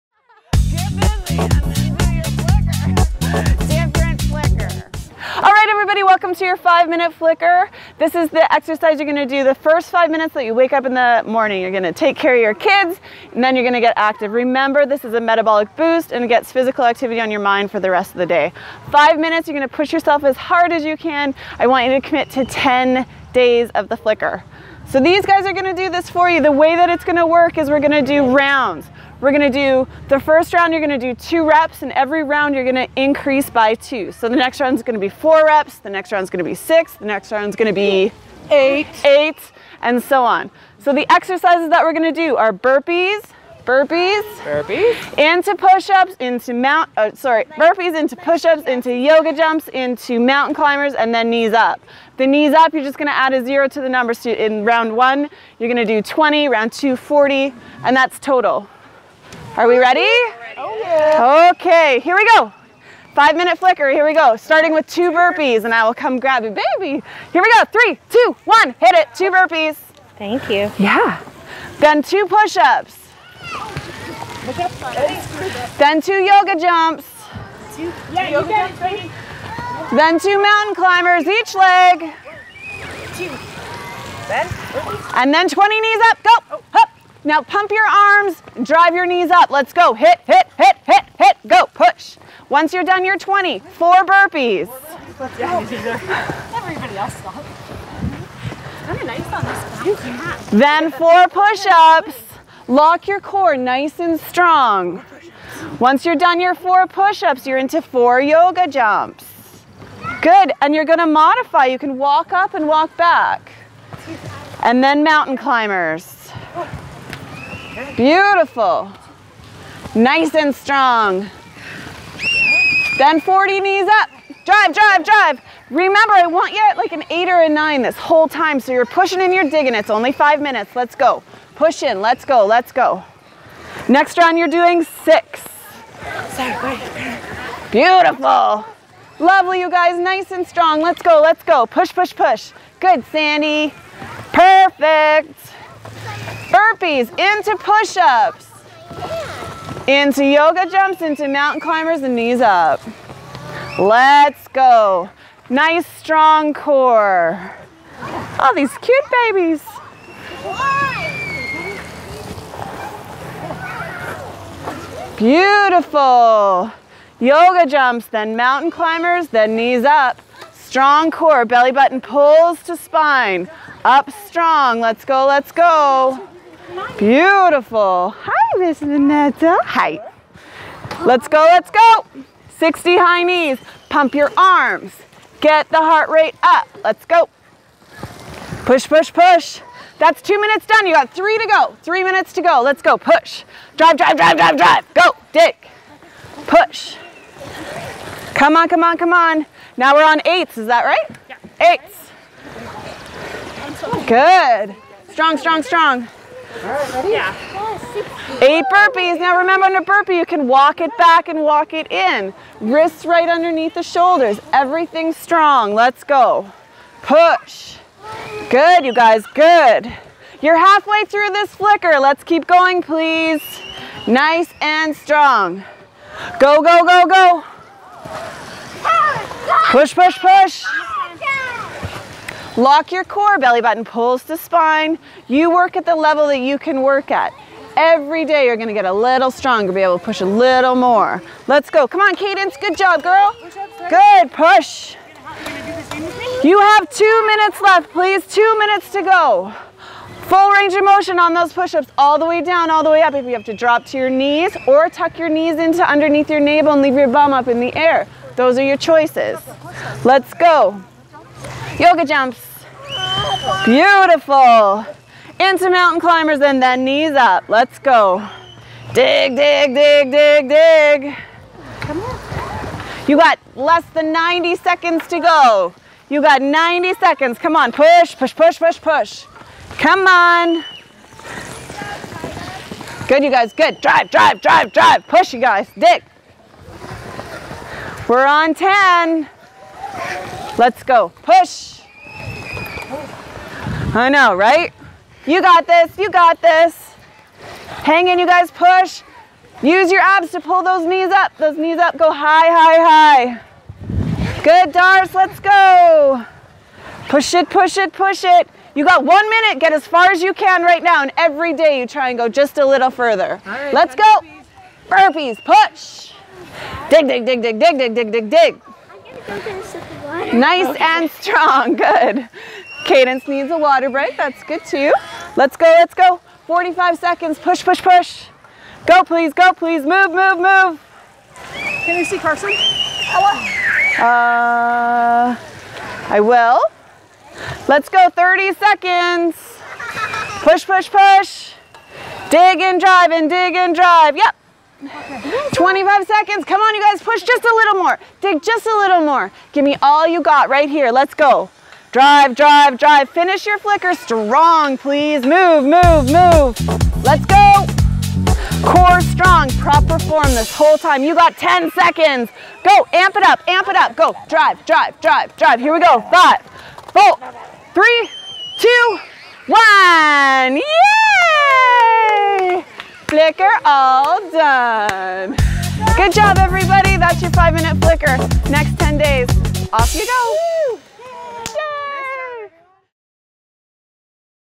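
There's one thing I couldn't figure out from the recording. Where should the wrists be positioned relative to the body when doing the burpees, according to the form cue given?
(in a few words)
Underneath the shoulders.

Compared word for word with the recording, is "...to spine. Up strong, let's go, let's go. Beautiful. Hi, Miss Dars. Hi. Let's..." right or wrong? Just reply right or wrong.
wrong.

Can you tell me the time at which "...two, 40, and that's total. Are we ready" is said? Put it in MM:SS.
00:56.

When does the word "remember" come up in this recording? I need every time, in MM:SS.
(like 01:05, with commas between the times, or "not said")
00:14, 02:05, 03:29.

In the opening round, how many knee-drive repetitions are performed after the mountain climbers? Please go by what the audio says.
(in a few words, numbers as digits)
20.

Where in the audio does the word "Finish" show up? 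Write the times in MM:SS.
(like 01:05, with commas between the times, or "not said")
05:53.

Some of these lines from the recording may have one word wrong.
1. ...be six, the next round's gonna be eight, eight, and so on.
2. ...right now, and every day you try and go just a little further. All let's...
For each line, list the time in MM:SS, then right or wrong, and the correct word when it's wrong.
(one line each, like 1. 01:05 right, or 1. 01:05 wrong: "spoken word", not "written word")
1. 00:36 right
2. 05:10 right.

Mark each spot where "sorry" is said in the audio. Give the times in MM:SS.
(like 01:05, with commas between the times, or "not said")
00:47.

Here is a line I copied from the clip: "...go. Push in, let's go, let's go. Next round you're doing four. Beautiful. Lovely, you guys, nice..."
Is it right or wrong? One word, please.
wrong.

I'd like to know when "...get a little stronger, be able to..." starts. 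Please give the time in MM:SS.
03:58.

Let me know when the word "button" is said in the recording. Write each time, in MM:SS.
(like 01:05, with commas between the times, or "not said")
02:51, 03:53.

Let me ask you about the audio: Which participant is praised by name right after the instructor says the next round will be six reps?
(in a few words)
Sandy.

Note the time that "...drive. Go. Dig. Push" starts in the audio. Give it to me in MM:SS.
03:14.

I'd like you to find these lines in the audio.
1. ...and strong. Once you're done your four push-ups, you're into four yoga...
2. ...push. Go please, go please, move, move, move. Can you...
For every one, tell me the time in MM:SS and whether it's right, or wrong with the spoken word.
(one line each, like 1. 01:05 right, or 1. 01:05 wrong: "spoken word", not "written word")
1. 01:43 right
2. 05:27 right.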